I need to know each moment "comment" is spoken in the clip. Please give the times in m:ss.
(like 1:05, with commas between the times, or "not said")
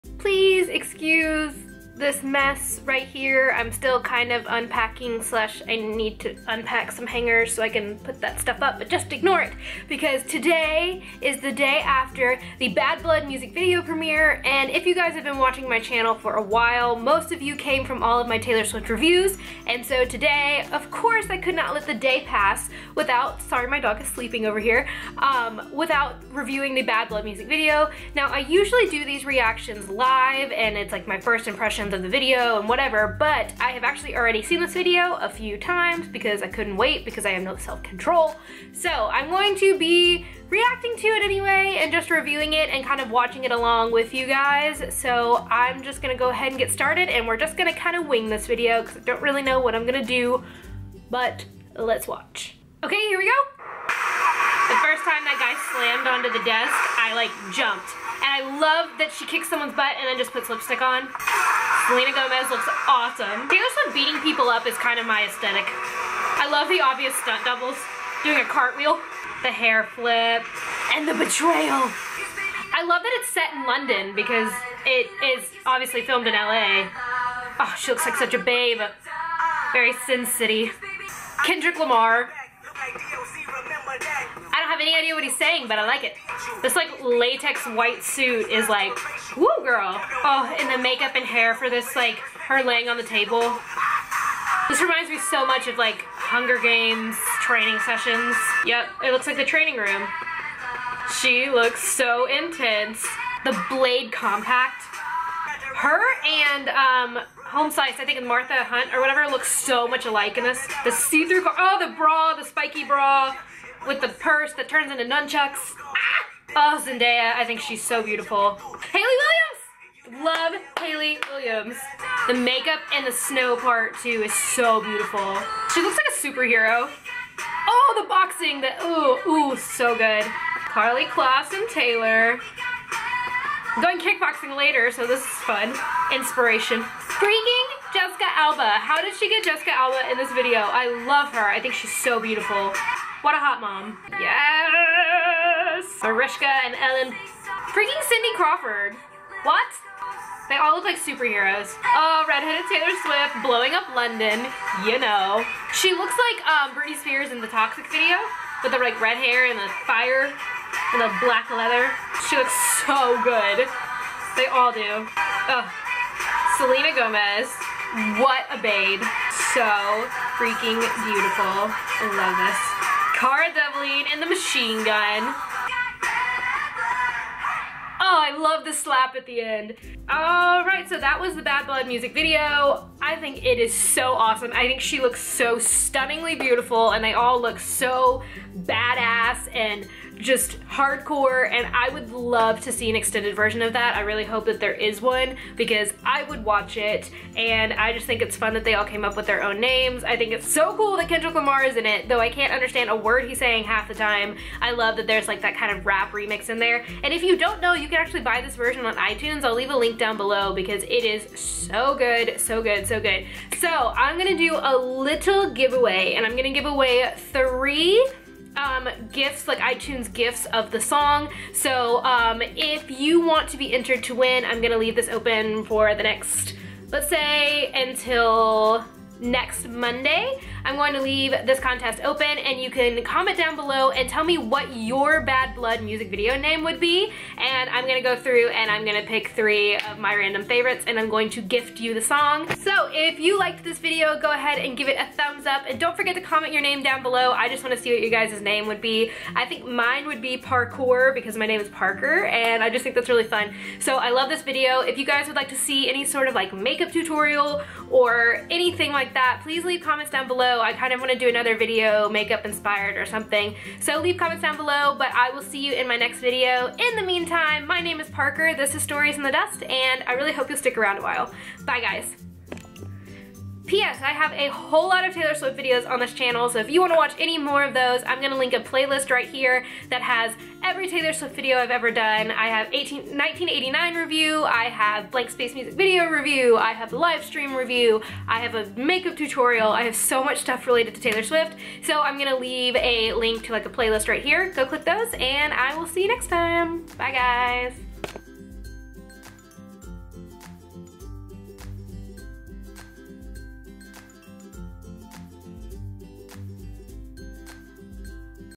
3:53, 4:06, 4:19, 4:24.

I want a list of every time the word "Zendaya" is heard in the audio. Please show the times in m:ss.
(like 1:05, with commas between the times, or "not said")
1:56.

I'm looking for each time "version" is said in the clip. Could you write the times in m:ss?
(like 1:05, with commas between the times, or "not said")
3:13, 3:28.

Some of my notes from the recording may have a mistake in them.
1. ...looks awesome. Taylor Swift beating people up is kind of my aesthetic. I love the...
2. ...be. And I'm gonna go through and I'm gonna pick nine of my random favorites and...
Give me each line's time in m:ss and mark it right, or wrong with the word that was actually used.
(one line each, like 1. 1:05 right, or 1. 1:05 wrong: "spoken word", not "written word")
1. 1:02 right
2. 3:56 wrong: "three", not "nine".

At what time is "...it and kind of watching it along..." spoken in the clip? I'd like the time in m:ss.
0:42.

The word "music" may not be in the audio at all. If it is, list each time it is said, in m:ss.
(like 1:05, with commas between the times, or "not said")
0:13, 0:27, 3:01, 3:55, 4:45.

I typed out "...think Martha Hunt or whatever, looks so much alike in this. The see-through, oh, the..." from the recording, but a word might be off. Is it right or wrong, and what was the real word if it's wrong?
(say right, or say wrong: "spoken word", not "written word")
right.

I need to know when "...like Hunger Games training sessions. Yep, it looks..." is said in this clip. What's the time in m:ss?
1:35.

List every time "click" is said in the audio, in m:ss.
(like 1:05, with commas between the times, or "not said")
4:54.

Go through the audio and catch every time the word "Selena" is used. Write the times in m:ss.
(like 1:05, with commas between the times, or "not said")
1:01, 2:46.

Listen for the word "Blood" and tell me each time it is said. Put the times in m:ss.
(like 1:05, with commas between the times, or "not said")
0:13, 0:27, 3:01, 3:55.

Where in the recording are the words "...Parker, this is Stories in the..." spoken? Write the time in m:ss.
4:28.